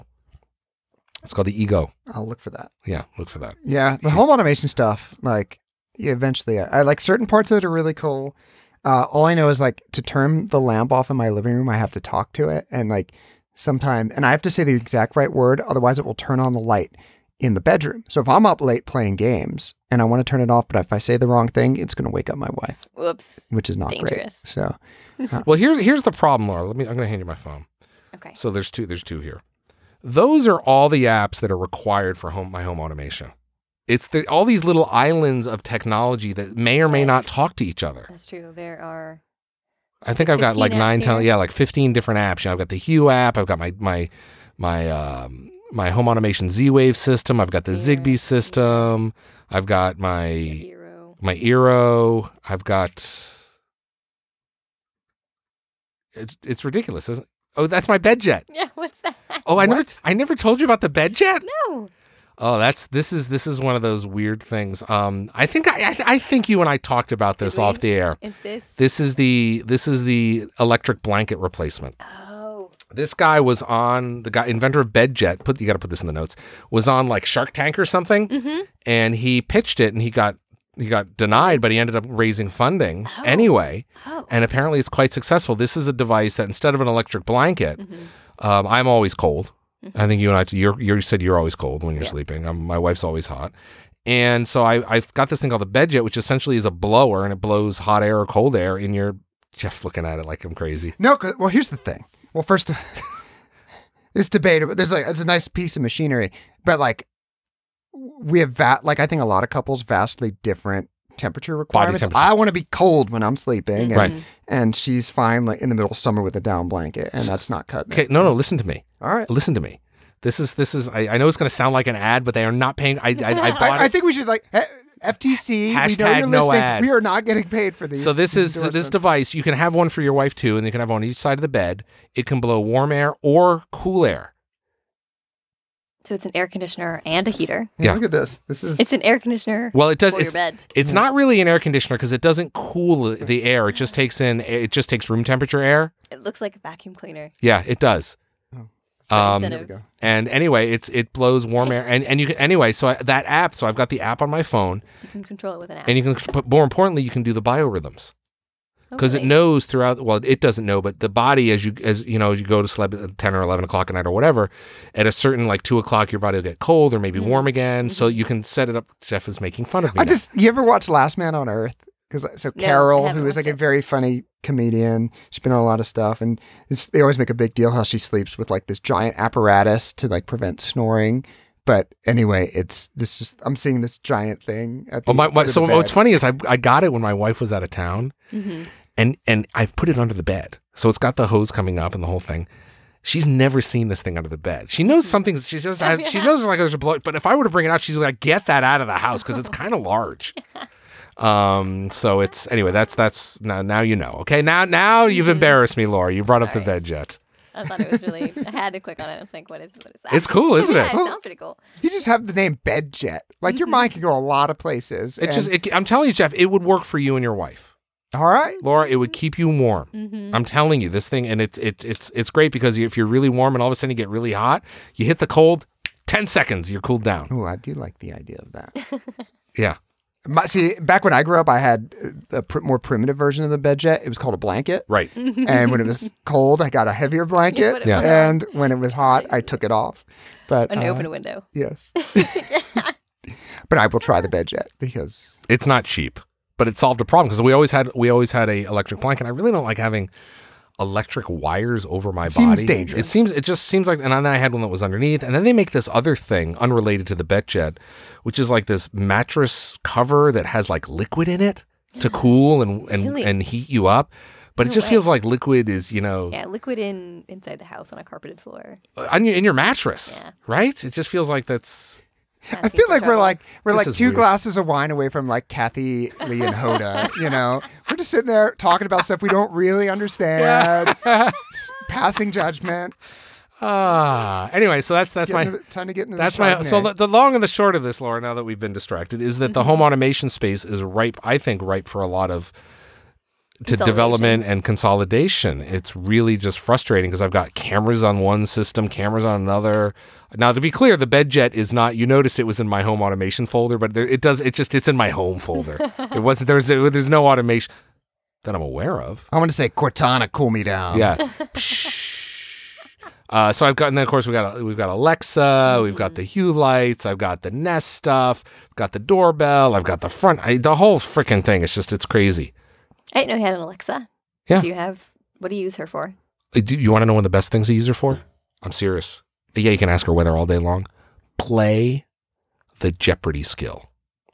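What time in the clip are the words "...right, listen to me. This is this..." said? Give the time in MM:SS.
01:59.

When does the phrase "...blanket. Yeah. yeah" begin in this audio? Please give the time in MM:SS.
03:57.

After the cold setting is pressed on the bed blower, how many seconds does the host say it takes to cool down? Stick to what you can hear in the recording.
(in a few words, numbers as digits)
10.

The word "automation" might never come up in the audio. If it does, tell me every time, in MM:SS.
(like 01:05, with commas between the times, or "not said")
00:04, 00:32, 00:46, 04:49, 05:03, 05:07.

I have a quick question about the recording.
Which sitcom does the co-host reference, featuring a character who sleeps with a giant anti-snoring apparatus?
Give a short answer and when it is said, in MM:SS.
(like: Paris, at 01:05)
Last Man on Earth, at 02:50.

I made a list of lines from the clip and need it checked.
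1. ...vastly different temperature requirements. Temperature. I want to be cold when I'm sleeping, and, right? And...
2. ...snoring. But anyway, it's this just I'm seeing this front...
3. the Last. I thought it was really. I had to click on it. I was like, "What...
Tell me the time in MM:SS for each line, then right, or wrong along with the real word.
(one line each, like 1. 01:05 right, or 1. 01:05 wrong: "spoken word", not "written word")
1. 01:49 right
2. 03:00 wrong: "giant", not "front"
3. 03:26 wrong: "BedJet", not "Last".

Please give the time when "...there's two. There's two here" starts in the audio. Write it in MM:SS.
00:28.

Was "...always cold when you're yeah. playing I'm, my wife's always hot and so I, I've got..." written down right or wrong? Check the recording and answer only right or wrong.
wrong.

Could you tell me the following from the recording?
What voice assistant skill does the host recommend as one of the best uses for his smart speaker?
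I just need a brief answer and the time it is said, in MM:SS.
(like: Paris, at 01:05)
Jeopardy, at 05:32.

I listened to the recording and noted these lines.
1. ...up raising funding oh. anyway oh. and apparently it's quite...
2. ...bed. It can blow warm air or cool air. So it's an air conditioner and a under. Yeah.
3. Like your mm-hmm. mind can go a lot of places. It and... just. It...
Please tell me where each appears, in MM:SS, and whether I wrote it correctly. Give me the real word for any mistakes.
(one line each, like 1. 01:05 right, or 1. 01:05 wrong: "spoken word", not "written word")
1. 01:21 right
2. 02:11 wrong: "heater", not "under"
3. 03:33 right.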